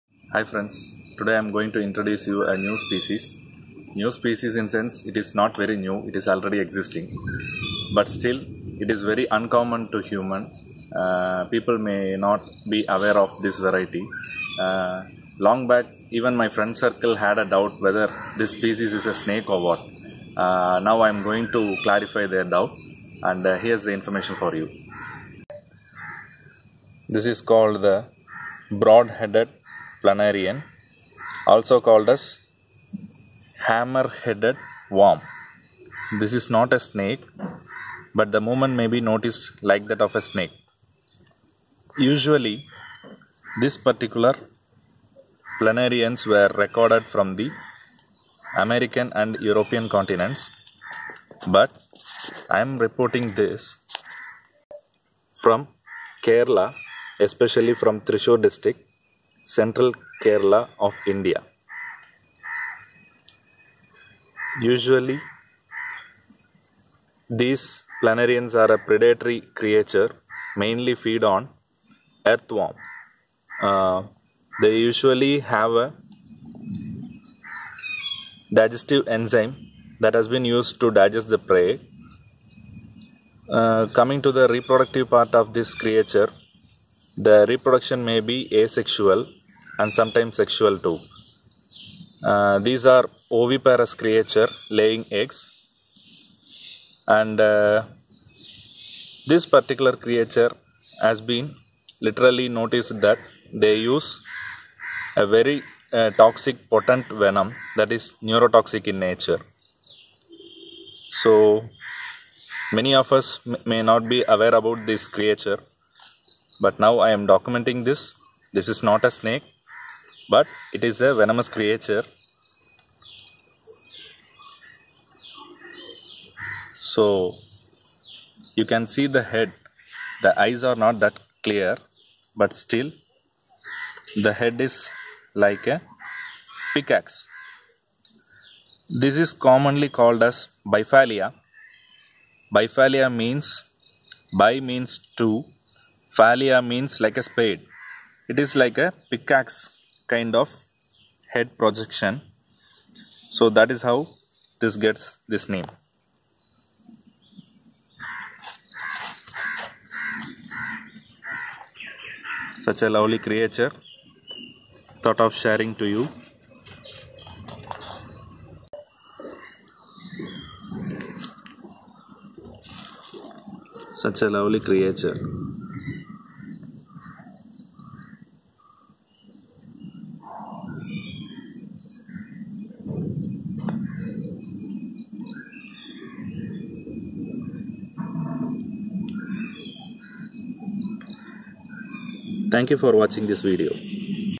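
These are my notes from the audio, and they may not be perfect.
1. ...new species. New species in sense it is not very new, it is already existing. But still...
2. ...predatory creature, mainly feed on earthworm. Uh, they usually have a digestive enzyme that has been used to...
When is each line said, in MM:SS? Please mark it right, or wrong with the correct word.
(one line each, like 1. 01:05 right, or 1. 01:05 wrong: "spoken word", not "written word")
1. 00:02 right
2. 01:08 right.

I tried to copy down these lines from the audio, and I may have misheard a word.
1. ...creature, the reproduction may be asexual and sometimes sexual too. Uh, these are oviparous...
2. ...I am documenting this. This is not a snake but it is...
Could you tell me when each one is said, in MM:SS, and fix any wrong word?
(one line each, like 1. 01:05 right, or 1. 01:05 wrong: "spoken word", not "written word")
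1. 01:25 right
2. 01:56 right.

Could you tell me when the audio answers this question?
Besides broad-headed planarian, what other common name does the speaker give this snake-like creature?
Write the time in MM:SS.
00:33.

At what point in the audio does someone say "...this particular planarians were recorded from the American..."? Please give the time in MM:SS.
00:43.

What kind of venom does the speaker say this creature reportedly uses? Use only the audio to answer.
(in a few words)
Neurotoxic.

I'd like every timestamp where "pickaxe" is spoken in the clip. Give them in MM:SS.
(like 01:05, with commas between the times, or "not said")
02:16, 02:29.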